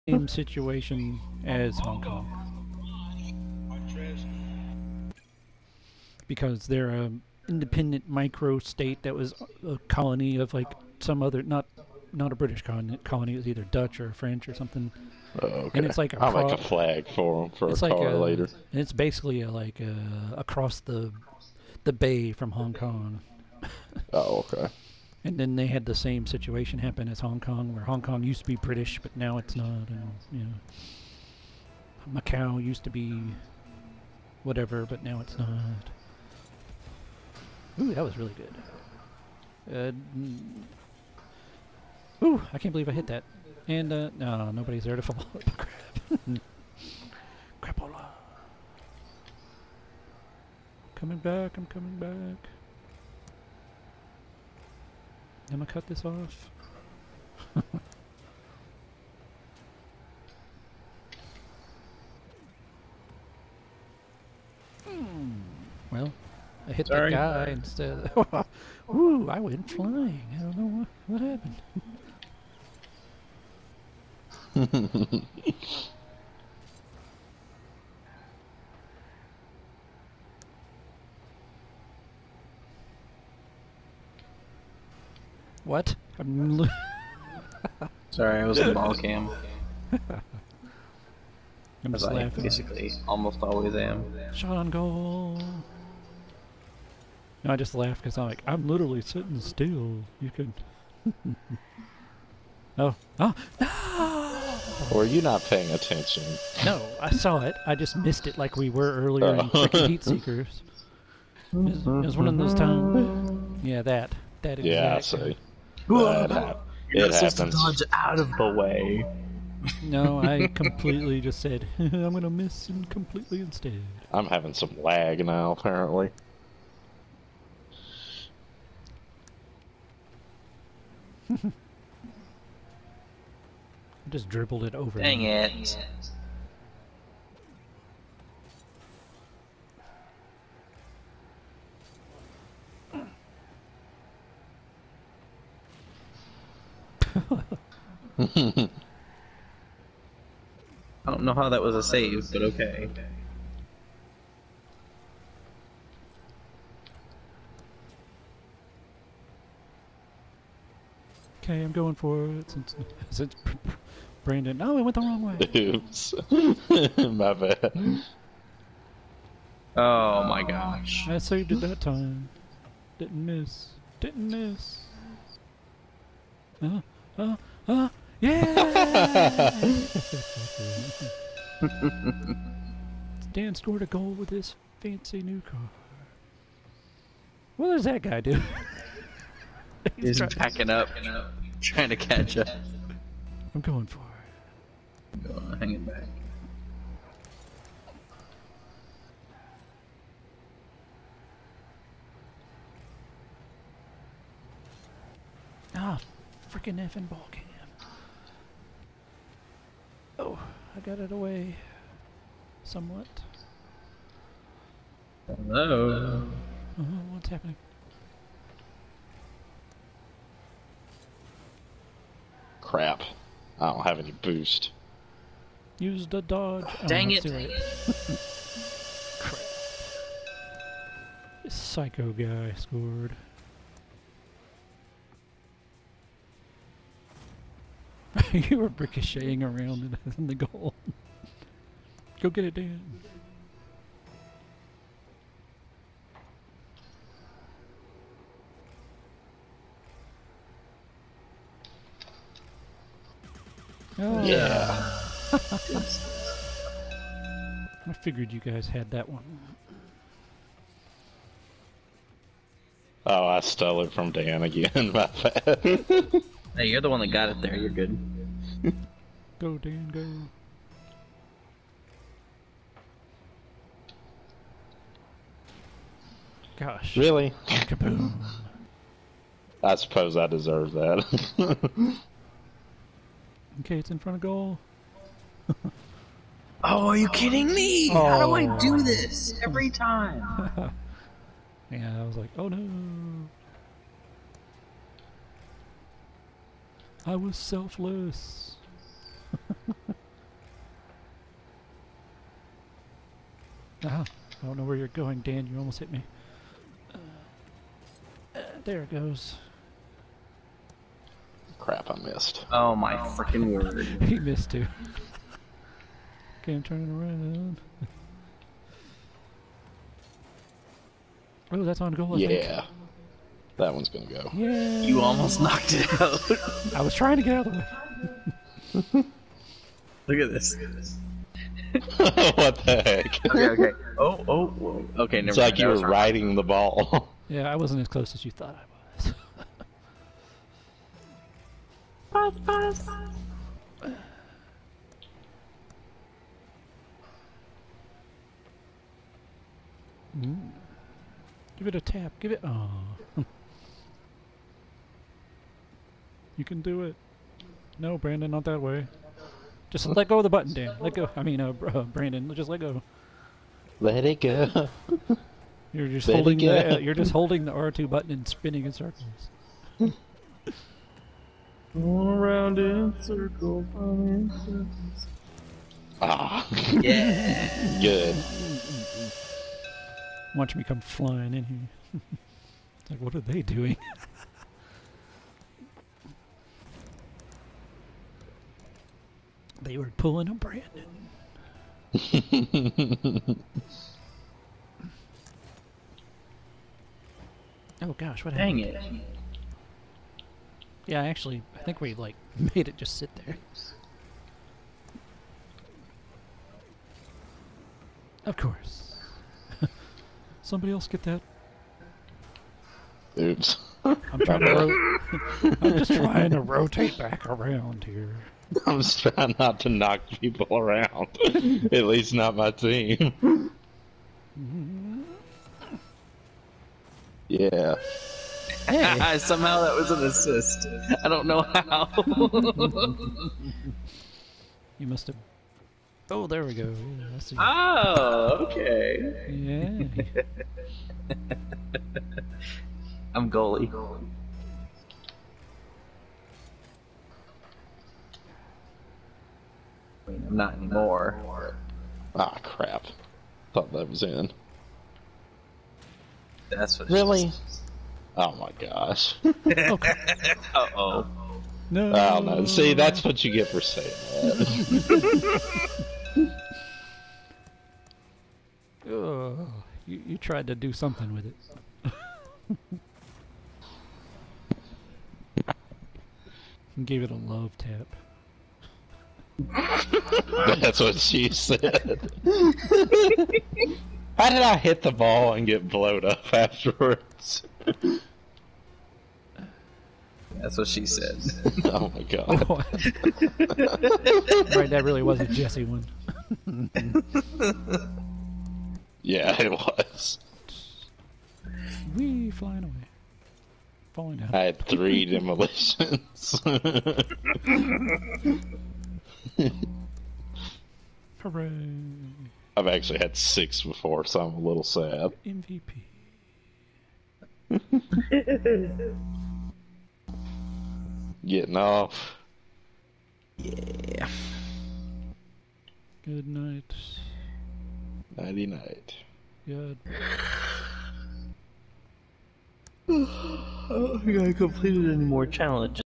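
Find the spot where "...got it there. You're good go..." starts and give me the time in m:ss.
4:27.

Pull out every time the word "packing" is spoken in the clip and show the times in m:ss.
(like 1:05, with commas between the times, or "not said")
3:10.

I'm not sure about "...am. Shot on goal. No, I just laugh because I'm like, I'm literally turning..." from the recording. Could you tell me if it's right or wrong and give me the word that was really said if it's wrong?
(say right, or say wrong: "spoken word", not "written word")
wrong: "sitting", not "turning".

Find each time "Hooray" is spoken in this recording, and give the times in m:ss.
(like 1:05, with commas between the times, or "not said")
8:31.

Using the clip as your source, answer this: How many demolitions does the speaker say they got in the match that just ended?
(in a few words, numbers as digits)
3.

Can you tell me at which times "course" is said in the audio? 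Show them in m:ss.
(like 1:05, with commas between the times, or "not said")
6:48.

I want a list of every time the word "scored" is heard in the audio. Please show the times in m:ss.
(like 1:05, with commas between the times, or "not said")
3:03, 3:52.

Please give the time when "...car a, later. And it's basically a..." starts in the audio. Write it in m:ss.
0:17.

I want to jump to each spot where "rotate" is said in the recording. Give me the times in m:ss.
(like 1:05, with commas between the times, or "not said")
6:56.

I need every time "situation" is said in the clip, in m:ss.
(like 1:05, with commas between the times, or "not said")
0:00, 0:26.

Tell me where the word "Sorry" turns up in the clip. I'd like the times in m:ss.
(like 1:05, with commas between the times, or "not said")
1:06, 1:28.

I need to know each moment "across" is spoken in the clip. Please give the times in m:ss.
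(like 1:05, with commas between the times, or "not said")
0:20.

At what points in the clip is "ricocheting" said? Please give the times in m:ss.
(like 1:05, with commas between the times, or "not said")
3:58.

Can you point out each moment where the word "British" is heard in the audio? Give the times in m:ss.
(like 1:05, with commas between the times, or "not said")
0:12, 0:28.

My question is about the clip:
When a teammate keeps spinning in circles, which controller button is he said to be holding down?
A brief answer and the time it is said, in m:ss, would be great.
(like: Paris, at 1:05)
R2, at 6:07.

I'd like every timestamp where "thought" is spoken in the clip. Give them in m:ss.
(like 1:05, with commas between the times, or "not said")
5:38, 7:33.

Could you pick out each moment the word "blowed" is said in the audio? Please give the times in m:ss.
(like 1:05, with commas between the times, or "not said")
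8:05.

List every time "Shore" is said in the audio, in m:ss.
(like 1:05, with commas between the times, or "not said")
not said.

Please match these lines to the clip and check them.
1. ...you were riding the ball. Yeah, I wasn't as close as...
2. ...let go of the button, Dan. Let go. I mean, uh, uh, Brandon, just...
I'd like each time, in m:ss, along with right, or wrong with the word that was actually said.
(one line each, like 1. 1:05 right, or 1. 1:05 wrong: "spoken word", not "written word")
1. 5:35 right
2. 5:59 right.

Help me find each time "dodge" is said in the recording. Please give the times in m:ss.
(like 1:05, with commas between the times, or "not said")
1:57, 3:46.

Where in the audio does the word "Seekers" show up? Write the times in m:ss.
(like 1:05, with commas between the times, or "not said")
1:50.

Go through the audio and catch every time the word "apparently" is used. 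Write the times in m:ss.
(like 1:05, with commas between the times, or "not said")
2:05.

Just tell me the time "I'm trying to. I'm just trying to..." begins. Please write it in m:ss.
6:53.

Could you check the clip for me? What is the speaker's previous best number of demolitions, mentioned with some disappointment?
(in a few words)
6.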